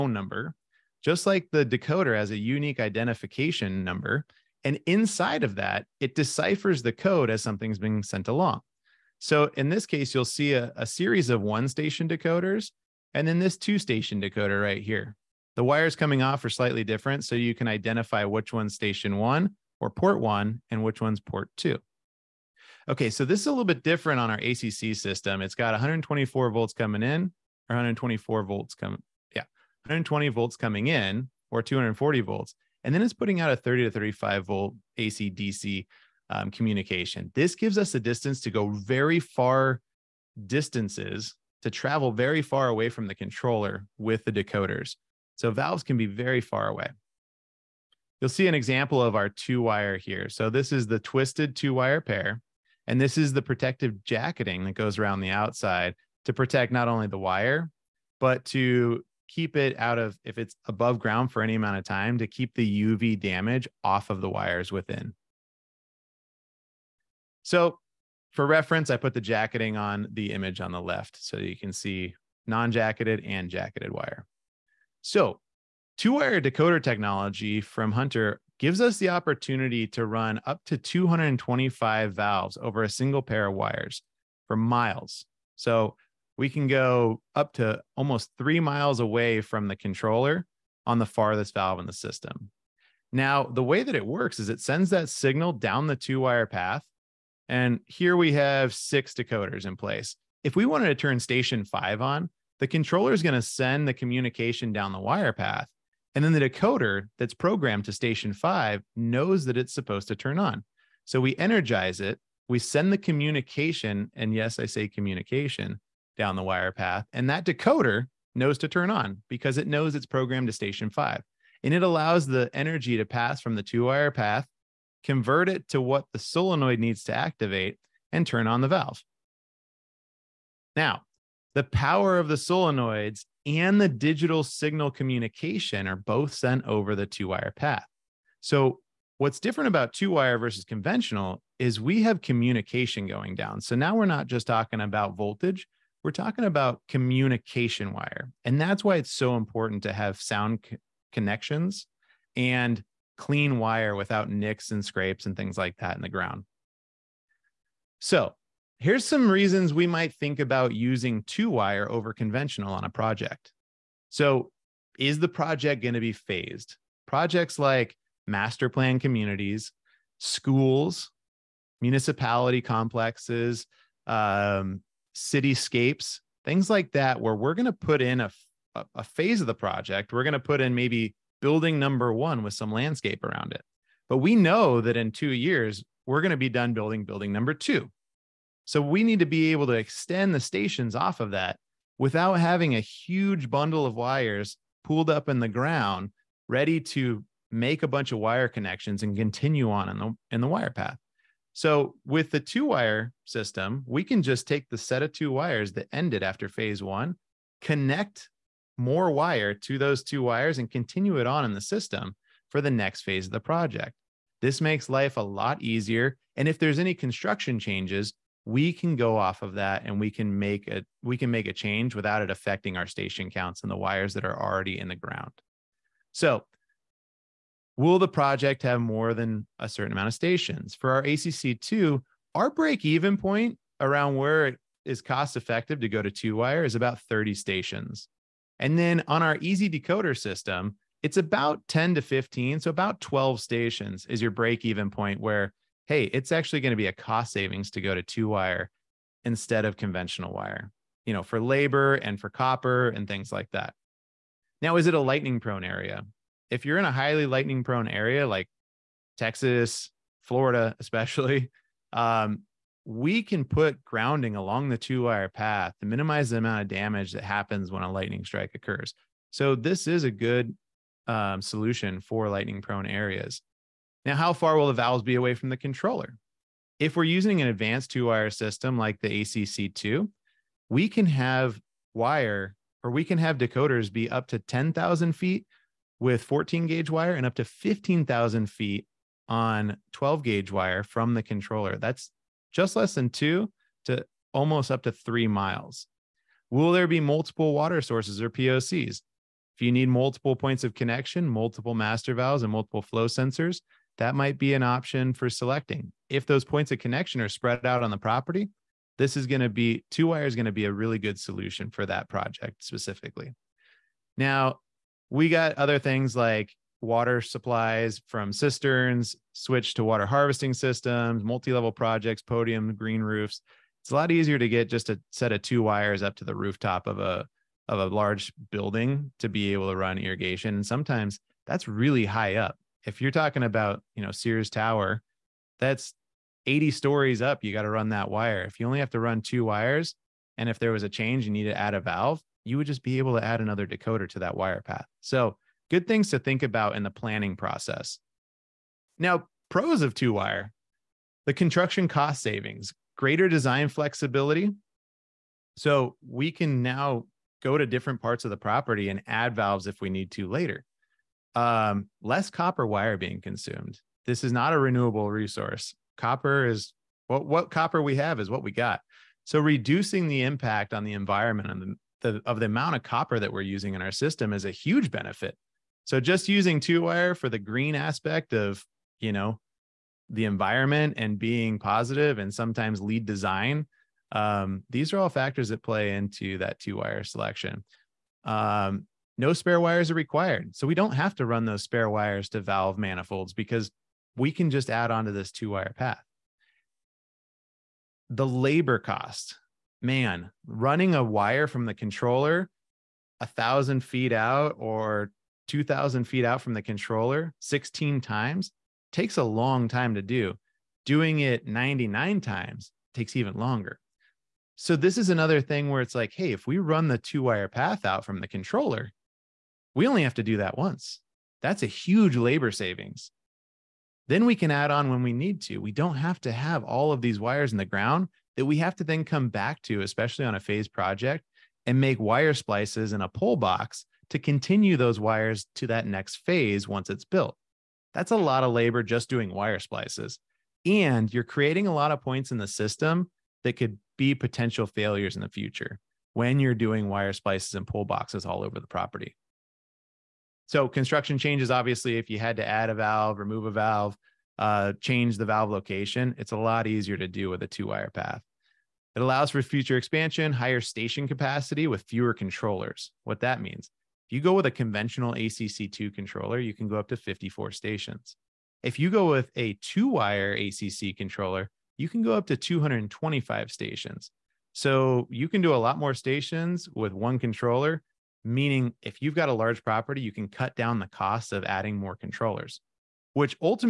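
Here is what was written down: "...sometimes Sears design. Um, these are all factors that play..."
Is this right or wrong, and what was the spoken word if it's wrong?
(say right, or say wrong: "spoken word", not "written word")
wrong: "LEED", not "Sears".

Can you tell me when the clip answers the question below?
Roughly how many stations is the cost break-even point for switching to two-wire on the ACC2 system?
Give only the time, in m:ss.
3:57.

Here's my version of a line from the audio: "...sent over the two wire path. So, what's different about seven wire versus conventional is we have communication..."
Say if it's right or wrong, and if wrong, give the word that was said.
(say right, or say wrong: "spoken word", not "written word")
wrong: "two", not "seven".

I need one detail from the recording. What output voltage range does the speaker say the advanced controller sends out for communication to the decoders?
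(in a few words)
30 to 35 volt.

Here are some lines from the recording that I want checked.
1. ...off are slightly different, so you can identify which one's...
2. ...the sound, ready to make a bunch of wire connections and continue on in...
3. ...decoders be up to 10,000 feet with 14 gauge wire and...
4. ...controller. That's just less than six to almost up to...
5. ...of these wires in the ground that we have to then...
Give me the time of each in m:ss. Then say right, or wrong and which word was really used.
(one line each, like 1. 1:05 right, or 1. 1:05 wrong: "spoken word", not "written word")
1. 0:16 right
2. 3:15 wrong: "ground", not "sound"
3. 4:43 right
4. 4:51 wrong: "two", not "six"
5. 7:06 right.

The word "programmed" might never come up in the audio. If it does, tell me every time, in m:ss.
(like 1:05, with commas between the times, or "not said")
1:47, 2:00.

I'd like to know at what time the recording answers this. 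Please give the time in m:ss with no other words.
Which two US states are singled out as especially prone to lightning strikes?
4:19.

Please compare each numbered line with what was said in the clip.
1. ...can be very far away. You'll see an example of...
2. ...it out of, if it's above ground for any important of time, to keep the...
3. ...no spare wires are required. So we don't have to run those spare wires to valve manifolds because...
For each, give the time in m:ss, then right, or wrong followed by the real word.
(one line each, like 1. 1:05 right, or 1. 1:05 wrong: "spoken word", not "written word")
1. 0:45 right
2. 0:59 wrong: "amount", not "important"
3. 6:29 right.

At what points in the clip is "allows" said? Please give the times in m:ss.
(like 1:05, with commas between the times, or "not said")
2:01, 7:38.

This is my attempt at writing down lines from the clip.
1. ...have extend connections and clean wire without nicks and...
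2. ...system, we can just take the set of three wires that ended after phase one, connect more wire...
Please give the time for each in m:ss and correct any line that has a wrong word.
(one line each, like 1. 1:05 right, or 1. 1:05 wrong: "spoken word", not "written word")
1. 2:29 wrong: "sound", not "extend"
2. 3:23 wrong: "two", not "three".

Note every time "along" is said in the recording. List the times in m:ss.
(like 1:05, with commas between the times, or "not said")
0:08, 4:24.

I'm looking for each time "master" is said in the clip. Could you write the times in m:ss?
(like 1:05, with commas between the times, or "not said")
2:48, 5:01.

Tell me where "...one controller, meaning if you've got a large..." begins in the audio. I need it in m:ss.
7:56.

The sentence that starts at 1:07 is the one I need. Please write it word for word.
So for reference, I put the jacketing on the image on the left so you can see non-jacketed and jacketed wire.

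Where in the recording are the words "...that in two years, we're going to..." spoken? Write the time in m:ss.
3:04.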